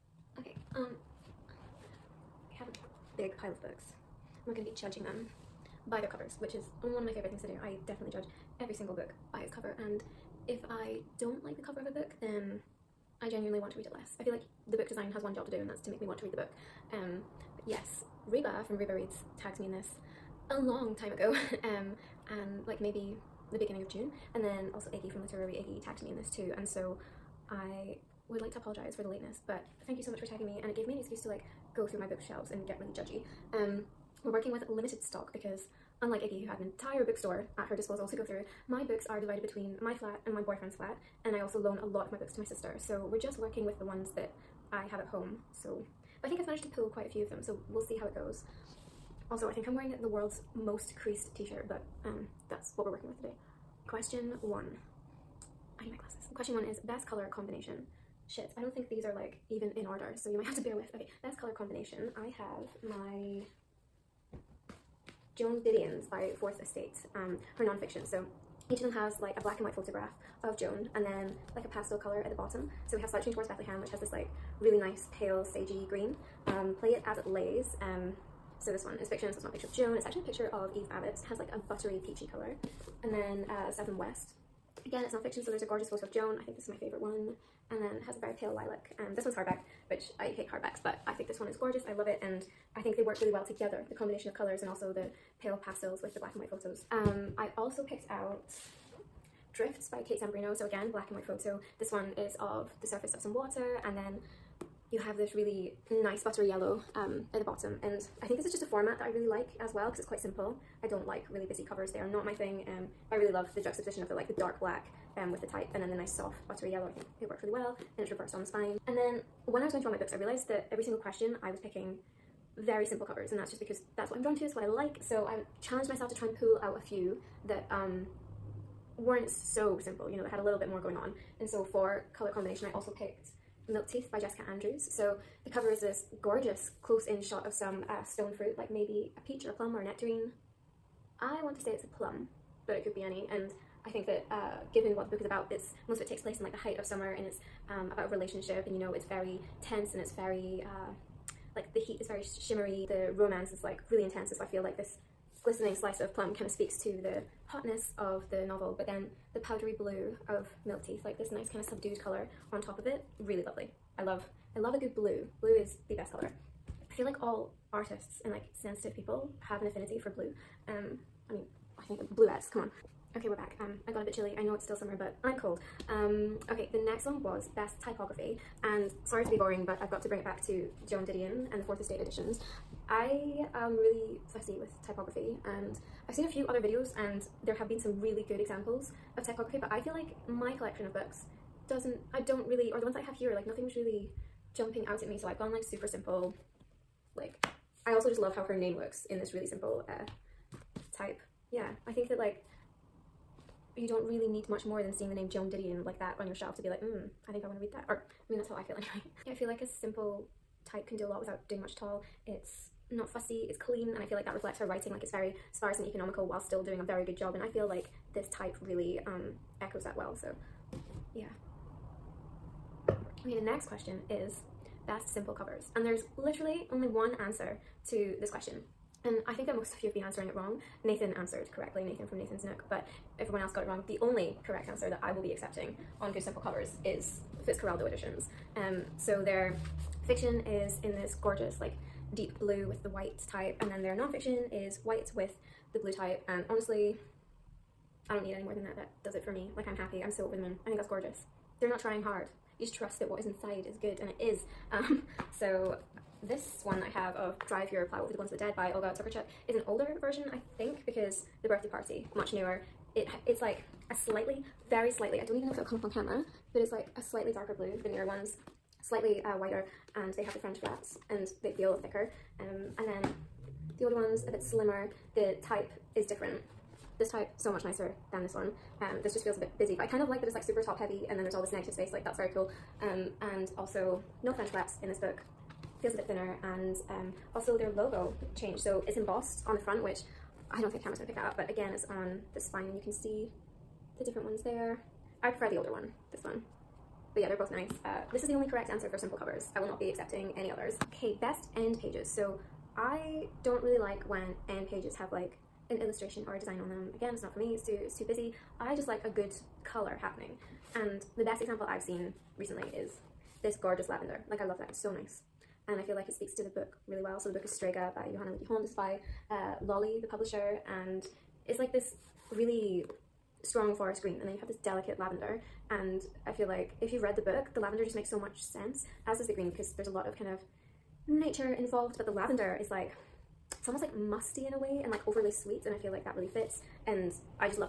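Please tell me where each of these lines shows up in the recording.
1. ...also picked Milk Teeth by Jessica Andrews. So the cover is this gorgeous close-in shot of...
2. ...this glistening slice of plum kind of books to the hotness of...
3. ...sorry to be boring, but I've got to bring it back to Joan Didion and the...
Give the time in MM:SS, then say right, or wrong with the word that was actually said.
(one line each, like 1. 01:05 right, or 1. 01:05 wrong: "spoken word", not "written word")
1. 02:12 right
2. 02:34 wrong: "speaks", not "books"
3. 02:59 right.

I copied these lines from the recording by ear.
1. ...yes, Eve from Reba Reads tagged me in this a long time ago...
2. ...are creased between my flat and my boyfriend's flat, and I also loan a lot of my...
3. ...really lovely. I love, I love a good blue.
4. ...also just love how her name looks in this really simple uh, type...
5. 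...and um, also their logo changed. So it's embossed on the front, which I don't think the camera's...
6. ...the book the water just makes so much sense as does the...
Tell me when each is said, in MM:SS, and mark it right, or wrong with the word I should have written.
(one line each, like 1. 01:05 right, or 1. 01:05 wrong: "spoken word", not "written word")
1. 00:17 wrong: "Reba", not "Eve"
2. 00:39 wrong: "divided", not "creased"
3. 02:43 right
4. 03:17 right
5. 04:46 right
6. 05:27 wrong: "lavender", not "water".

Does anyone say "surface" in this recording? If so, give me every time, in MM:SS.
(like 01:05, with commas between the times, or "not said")
01:42.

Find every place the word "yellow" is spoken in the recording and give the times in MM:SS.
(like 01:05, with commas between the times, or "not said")
01:46, 01:56.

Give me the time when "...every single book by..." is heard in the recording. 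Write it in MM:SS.
00:08.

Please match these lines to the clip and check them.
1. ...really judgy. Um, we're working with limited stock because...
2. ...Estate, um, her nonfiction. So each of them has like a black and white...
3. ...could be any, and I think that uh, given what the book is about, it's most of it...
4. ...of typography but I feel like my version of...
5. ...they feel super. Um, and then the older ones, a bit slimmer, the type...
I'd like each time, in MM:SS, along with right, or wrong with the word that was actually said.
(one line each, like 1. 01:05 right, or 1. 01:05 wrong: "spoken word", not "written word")
1. 00:32 right
2. 01:06 right
3. 02:22 right
4. 03:09 wrong: "collection", not "version"
5. 04:31 wrong: "thicker", not "super".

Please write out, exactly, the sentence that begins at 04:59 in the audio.
I will not be accepting any others pay best end pages.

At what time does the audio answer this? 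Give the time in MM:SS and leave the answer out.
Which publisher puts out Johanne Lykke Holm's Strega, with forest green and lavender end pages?
05:19.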